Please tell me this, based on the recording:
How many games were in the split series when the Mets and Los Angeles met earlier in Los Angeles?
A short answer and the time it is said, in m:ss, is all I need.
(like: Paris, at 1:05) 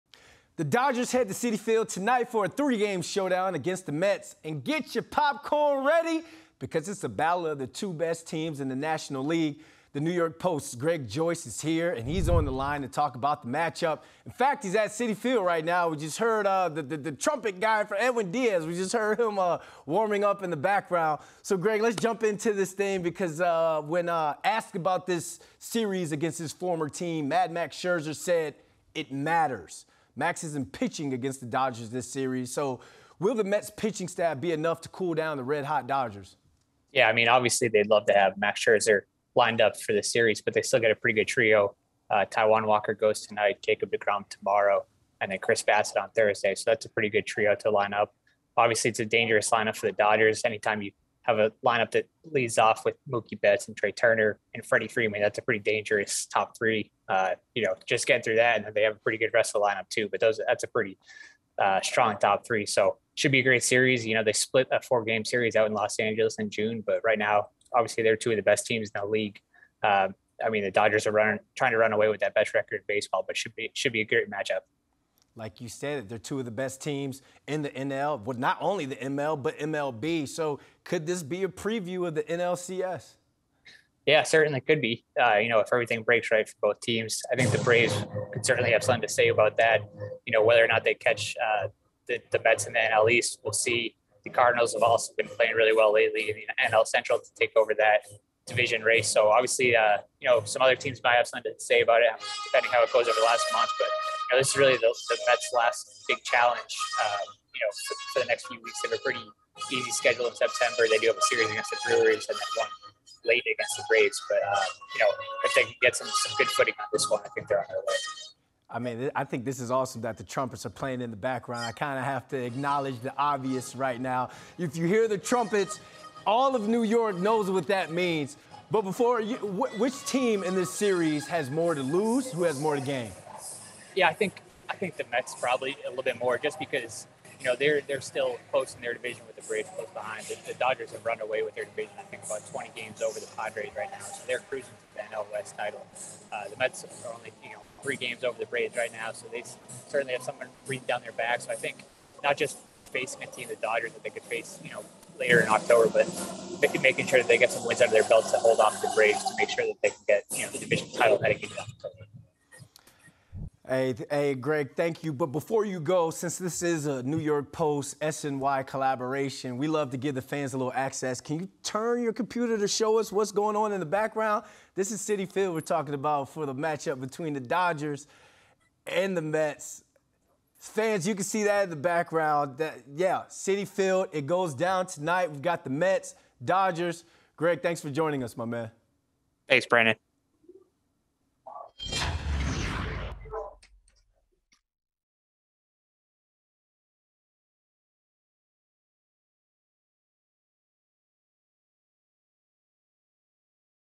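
4, at 1:04.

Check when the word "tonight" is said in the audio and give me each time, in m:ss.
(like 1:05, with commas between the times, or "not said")
0:01, 0:43, 3:04.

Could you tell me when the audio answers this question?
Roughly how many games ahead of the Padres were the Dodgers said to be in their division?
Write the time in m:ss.
2:22.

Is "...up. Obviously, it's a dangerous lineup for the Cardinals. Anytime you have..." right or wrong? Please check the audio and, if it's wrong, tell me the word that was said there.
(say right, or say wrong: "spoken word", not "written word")
wrong: "Dodgers", not "Cardinals".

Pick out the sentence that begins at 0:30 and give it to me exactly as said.
Max isn't pitching against the Dodgers this series.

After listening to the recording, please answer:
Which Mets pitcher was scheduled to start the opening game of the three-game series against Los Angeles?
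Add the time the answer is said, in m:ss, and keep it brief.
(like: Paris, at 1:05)
Taijuan Walker, at 0:42.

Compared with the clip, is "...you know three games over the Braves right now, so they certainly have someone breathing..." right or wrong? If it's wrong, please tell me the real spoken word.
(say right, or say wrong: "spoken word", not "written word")
right.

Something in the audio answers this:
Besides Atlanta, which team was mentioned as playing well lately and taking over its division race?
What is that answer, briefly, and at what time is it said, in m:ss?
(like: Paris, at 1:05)
Cardinals, at 1:34.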